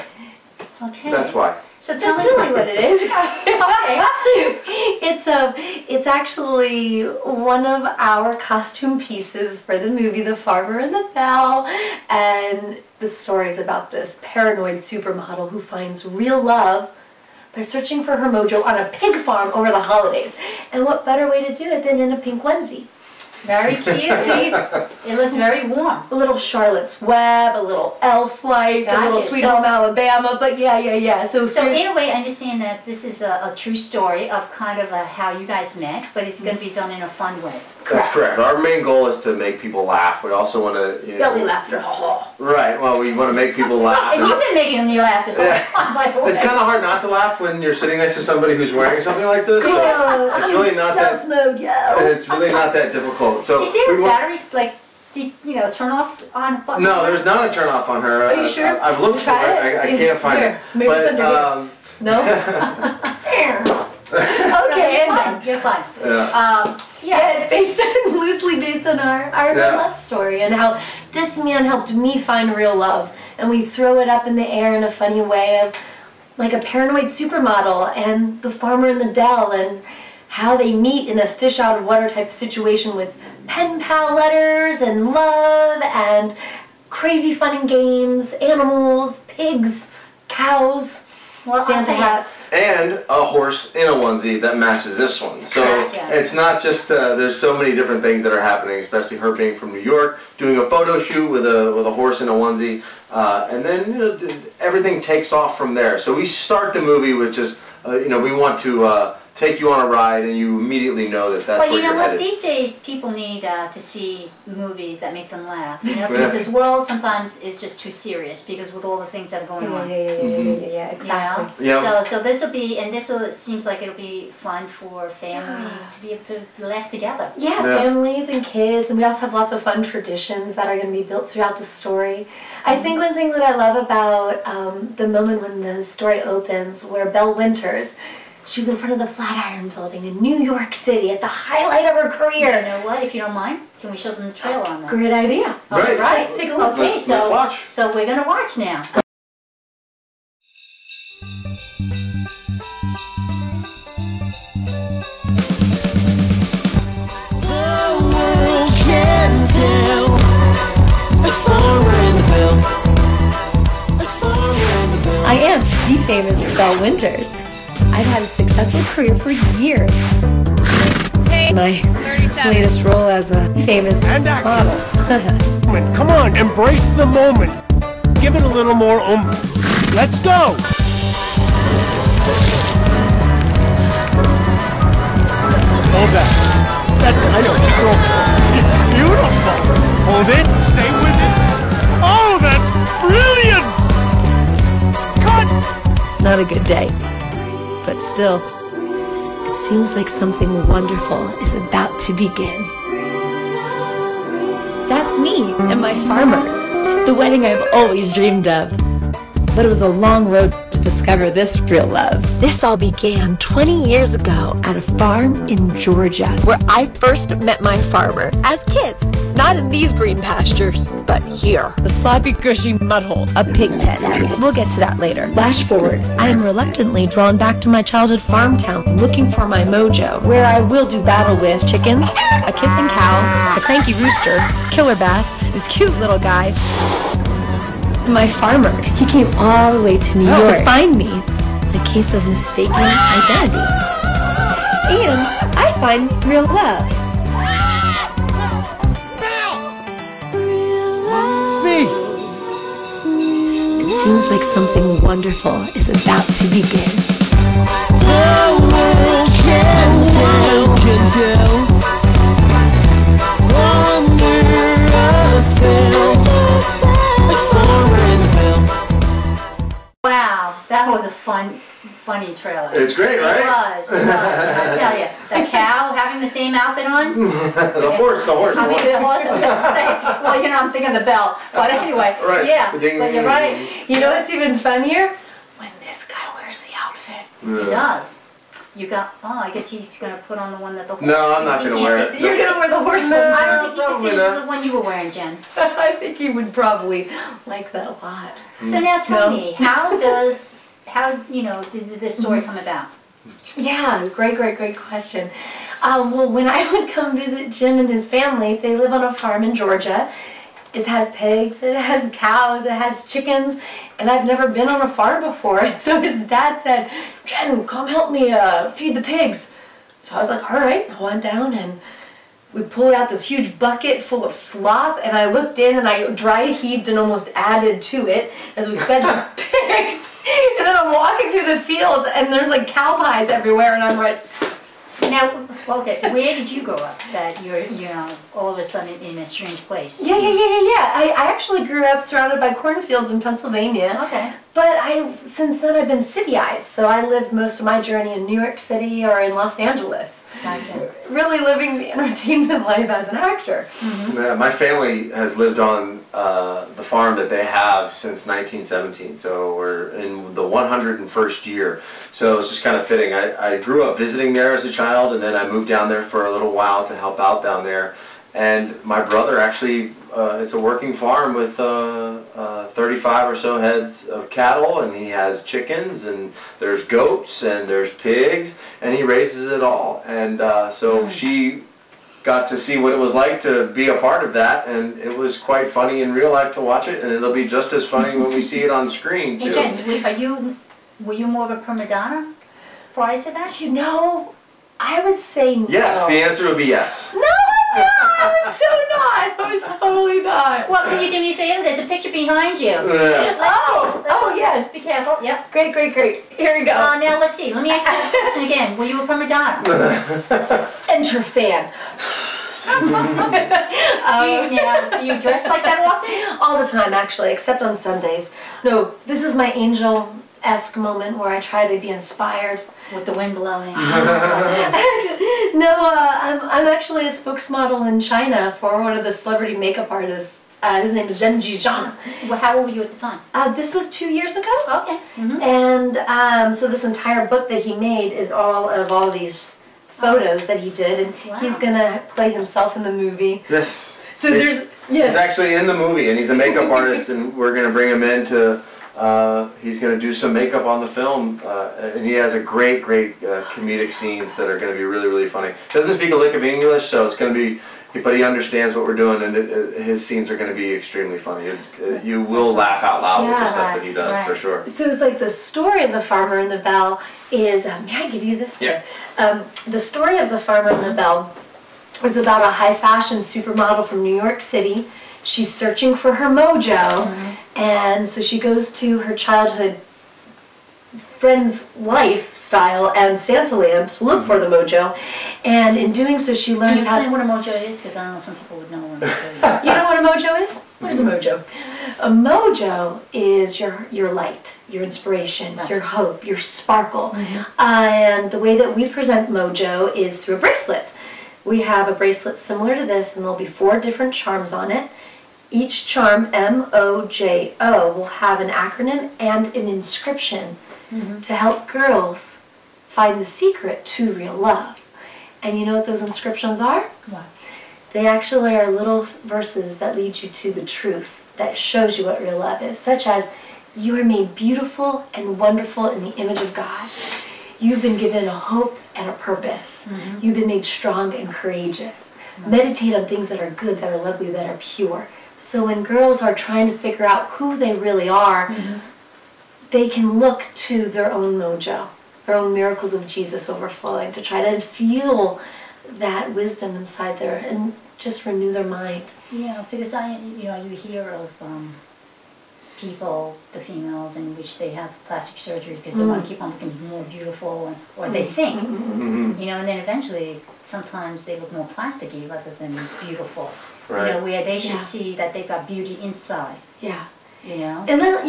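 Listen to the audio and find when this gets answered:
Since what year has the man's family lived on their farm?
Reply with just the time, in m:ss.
5:58.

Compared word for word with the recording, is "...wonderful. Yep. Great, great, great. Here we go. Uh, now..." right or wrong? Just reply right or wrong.
wrong.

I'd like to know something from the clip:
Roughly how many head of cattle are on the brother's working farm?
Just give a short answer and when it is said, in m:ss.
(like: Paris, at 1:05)
35, at 6:12.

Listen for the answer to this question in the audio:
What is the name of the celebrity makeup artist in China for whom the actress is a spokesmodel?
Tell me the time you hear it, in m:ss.
7:11.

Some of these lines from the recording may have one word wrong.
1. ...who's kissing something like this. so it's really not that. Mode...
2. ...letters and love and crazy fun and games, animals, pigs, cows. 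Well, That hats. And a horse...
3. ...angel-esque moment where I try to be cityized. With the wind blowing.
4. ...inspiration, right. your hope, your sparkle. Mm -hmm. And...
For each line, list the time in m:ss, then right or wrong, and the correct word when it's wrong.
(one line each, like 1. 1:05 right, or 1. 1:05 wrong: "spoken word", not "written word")
1. 0:48 wrong: "wearing", not "kissing"
2. 1:24 wrong: "Santa", not "That"
3. 6:59 wrong: "inspired", not "cityized"
4. 8:14 right.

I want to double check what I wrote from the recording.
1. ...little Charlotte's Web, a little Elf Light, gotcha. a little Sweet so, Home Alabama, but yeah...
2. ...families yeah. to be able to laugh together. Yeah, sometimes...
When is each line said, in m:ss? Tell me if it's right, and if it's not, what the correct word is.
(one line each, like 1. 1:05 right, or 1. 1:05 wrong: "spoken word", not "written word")
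1. 0:26 right
2. 2:05 wrong: "families", not "sometimes".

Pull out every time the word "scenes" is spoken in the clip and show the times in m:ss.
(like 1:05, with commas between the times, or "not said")
7:33, 7:40.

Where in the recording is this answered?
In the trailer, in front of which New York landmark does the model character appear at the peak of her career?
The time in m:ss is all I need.
2:19.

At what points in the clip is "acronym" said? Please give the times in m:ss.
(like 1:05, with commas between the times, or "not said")
8:28.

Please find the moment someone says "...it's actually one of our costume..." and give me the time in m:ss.
0:05.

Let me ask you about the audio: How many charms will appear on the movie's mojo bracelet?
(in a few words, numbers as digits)
4.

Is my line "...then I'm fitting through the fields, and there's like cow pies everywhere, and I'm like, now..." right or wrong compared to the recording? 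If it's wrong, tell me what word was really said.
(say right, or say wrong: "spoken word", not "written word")
wrong: "walking", not "fitting".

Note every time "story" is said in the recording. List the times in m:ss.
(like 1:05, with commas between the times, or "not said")
0:13, 0:33, 1:09, 2:11, 2:15, 5:02, 7:45, 7:49.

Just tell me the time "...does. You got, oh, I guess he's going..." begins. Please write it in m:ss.
4:47.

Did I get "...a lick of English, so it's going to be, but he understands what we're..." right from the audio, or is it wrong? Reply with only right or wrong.
right.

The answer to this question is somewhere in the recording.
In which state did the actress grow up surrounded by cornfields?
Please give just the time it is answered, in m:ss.
5:43.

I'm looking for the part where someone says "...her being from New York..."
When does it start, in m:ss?
1:39.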